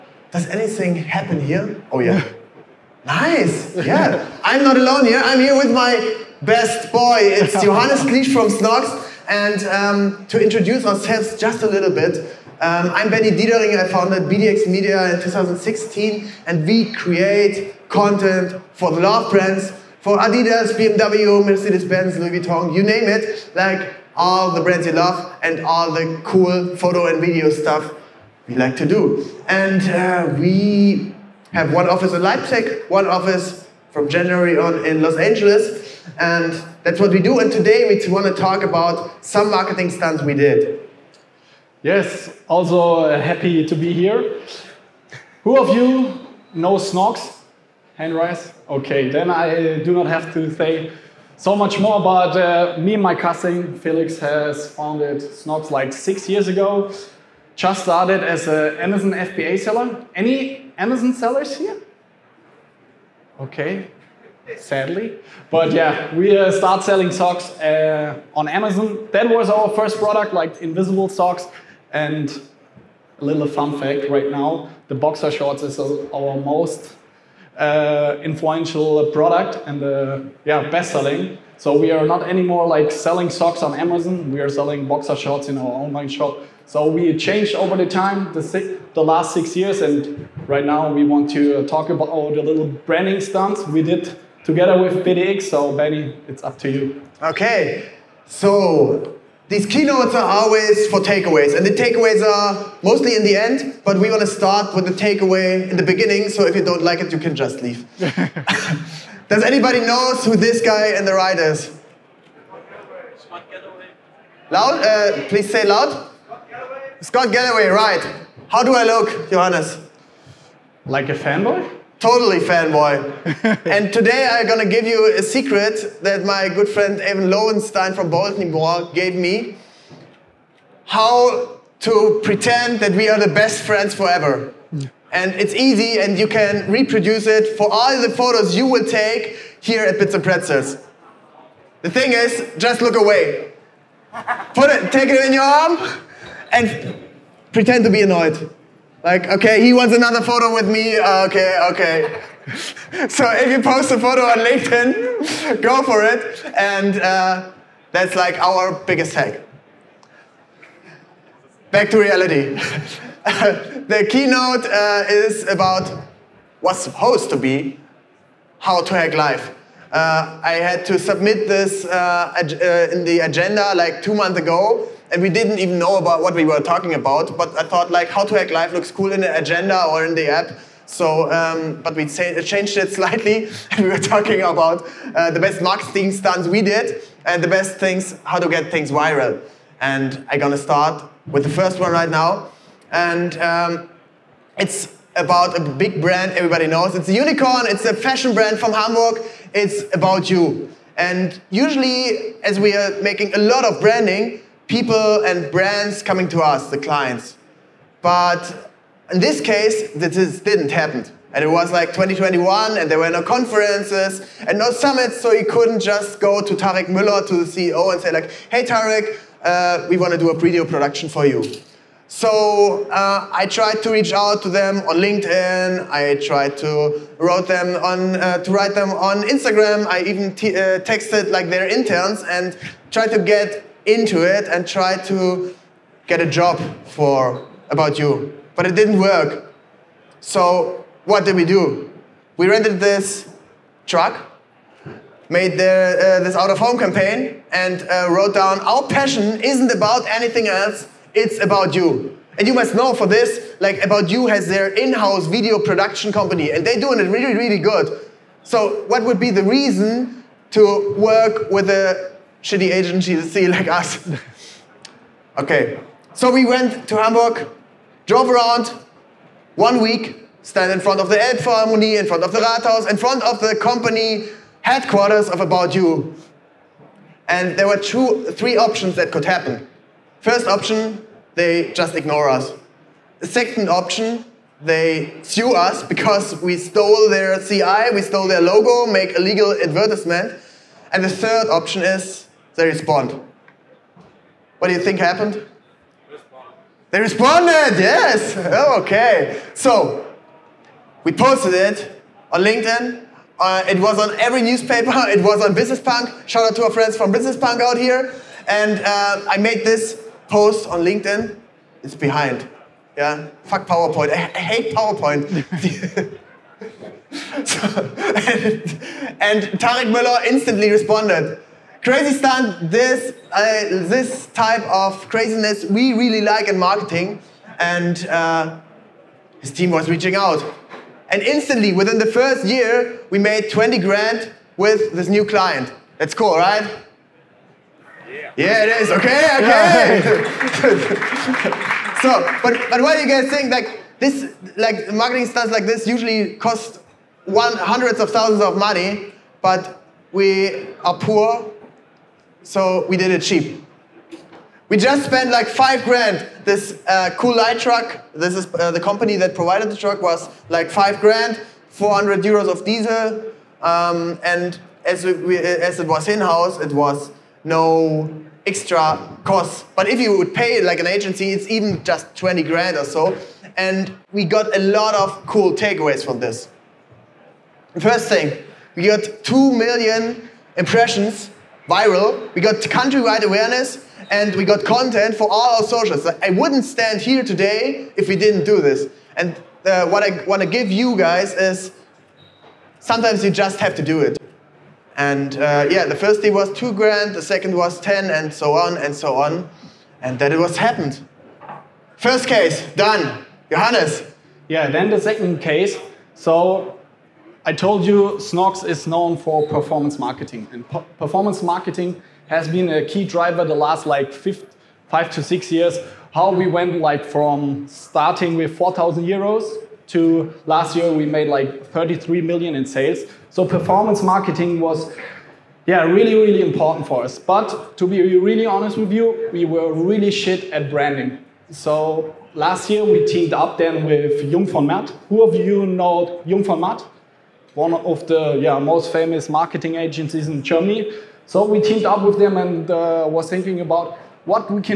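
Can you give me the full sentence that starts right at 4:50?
And the third option is they respond.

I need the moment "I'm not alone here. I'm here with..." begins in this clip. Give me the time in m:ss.
0:04.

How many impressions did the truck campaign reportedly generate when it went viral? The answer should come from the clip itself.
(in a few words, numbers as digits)
2 million.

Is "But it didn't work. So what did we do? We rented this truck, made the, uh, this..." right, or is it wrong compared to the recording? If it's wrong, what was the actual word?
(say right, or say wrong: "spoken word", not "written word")
right.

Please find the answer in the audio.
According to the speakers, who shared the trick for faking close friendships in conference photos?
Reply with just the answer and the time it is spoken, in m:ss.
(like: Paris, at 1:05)
Evan Lowenstein, at 2:06.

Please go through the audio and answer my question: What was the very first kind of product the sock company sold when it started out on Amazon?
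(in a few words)
invisible socks.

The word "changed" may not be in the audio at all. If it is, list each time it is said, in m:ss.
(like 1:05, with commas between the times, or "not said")
1:27, 3:02.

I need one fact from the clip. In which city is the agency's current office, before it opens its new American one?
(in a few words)
Leipzig.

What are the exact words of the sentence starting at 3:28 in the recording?
But in this case, this didn't happen.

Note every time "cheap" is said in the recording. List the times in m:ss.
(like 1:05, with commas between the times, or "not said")
5:53.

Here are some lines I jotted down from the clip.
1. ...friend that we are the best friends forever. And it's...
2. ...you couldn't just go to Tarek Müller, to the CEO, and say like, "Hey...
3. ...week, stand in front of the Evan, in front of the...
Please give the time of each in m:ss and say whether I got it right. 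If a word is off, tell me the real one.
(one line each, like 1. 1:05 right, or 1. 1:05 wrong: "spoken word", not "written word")
1. 2:12 wrong: "pretend", not "friend"
2. 3:35 right
3. 4:29 wrong: "Elbphilharmonie", not "Evan".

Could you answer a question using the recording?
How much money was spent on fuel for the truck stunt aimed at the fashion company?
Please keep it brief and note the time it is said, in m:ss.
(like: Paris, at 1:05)
400 euros, at 6:01.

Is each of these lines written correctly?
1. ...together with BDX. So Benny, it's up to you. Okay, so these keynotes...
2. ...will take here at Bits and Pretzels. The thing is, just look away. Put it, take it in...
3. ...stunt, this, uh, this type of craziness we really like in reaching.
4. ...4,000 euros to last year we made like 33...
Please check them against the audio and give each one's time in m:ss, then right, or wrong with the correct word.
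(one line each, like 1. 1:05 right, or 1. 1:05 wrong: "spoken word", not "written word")
1. 1:34 right
2. 2:18 right
3. 5:22 wrong: "marketing", not "reaching"
4. 6:58 right.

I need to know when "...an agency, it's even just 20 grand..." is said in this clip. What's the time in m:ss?
6:10.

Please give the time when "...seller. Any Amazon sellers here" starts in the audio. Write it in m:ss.
0:59.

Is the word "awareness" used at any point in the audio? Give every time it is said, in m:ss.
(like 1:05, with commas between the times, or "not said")
6:23.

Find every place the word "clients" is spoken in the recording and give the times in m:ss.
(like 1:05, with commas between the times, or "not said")
3:26, 5:35.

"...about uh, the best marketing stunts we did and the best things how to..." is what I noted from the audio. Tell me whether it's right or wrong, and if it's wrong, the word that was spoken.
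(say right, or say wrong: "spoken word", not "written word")
right.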